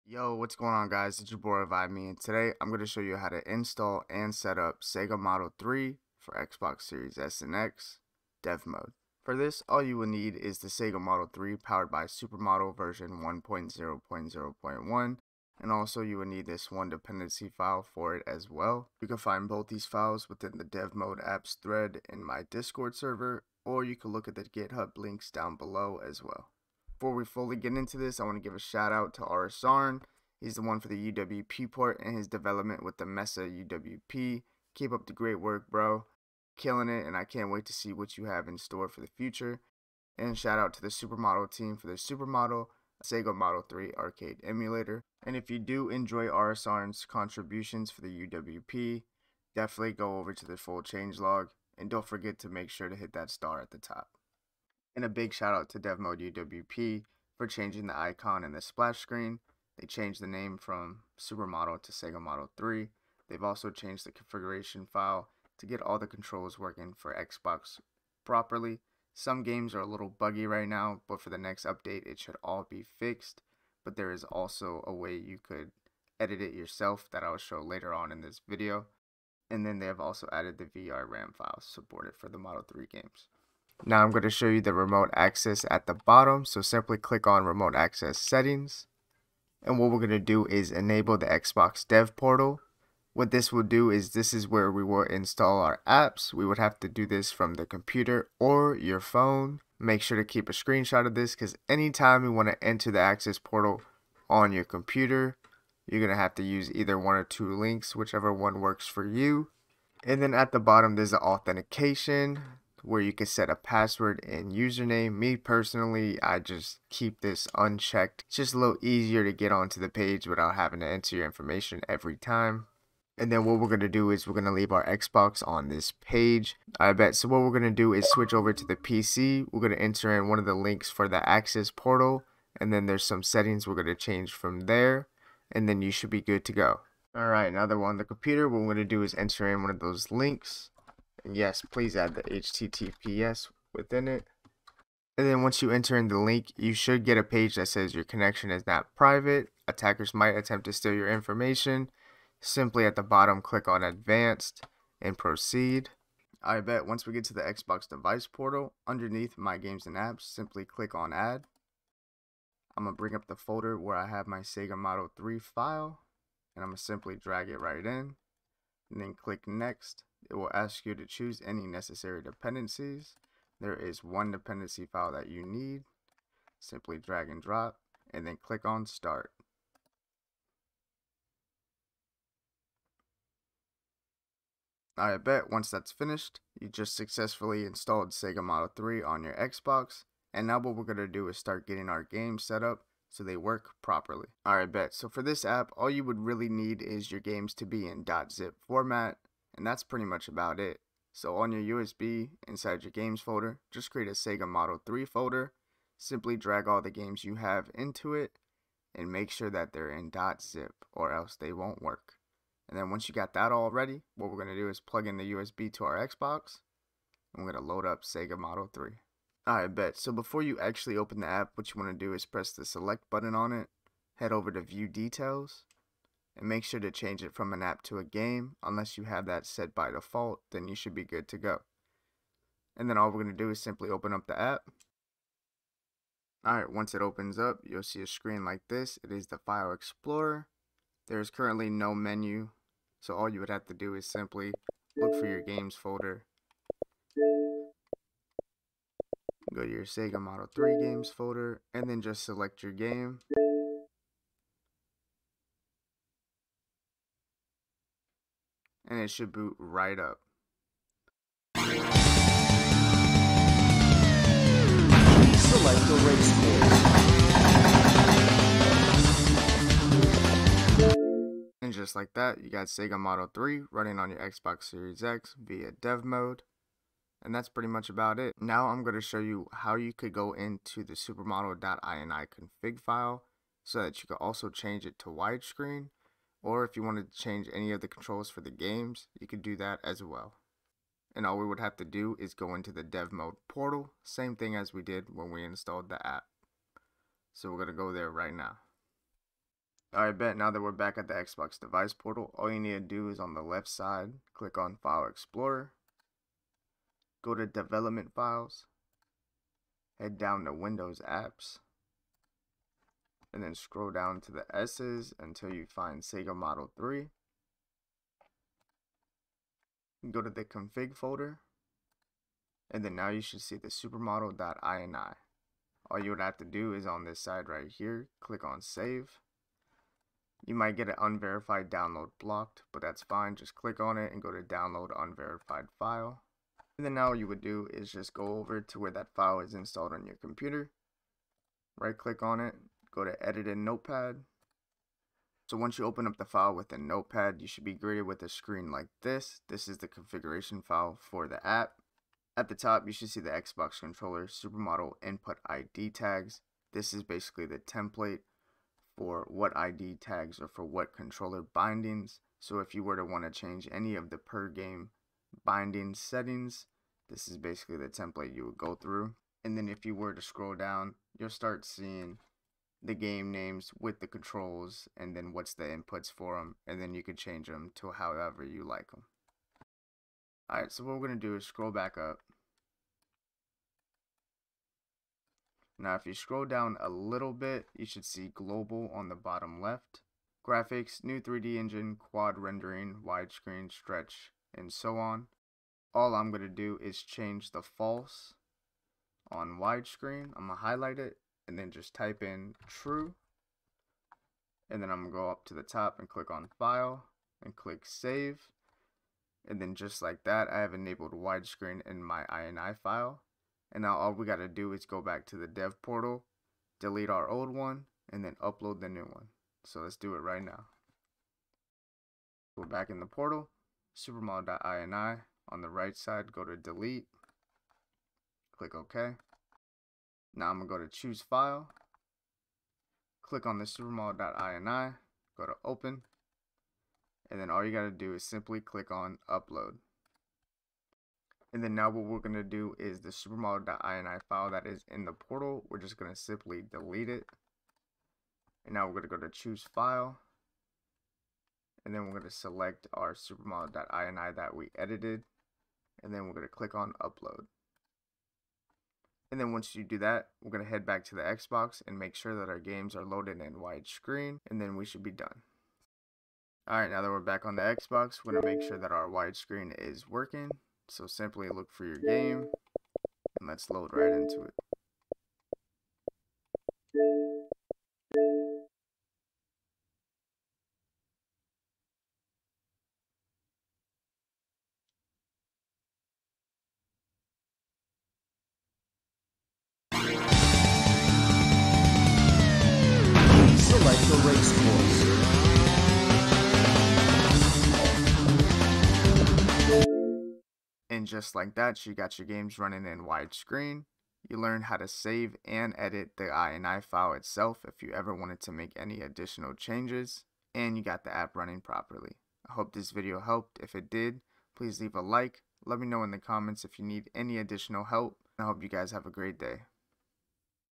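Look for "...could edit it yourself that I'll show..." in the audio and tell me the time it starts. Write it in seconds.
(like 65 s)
75 s.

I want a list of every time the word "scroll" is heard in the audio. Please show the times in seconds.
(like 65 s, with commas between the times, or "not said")
313 s, 370 s, 381 s, 386 s.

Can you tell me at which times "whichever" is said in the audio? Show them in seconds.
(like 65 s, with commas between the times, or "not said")
107 s.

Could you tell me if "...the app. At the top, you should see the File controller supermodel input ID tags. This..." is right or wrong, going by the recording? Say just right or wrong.
wrong.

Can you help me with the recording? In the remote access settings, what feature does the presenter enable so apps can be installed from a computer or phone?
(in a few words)
Xbox dev portal.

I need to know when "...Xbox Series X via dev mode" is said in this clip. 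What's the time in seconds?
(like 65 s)
274 s.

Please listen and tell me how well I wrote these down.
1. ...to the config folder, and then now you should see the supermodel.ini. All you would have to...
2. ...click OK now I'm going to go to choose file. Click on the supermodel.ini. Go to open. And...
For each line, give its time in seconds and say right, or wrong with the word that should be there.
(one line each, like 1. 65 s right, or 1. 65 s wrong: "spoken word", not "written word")
1. 320 s right
2. 428 s right.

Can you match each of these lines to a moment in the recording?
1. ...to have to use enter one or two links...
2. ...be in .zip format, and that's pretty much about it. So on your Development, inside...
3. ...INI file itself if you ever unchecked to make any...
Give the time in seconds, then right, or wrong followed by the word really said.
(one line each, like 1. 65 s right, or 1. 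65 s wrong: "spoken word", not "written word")
1. 106 s wrong: "either", not "enter"
2. 197 s wrong: "USB", not "Development"
3. 506 s wrong: "wanted", not "unchecked".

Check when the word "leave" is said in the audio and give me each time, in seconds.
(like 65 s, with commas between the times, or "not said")
124 s, 514 s.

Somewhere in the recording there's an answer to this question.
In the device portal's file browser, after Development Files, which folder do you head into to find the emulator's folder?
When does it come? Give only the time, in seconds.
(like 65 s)
310 s.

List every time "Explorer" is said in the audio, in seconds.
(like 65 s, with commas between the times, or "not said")
239 s, 305 s.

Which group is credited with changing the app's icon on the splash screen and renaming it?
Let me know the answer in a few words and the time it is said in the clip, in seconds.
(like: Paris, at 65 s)
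DevMode UWP, at 55 s.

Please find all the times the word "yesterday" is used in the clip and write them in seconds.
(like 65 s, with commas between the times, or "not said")
not said.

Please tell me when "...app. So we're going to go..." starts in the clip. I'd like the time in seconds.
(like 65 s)
296 s.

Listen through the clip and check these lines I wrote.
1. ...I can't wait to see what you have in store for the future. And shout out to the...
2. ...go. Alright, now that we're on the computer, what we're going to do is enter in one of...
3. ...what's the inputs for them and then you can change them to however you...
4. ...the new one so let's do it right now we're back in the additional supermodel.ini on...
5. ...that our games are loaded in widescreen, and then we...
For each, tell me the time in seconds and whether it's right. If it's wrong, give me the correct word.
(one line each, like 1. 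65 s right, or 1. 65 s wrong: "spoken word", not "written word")
1. 37 s right
2. 136 s right
3. 375 s right
4. 418 s wrong: "portal", not "additional"
5. 462 s right.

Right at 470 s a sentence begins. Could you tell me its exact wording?
So simply look for your game, and let's load right into it.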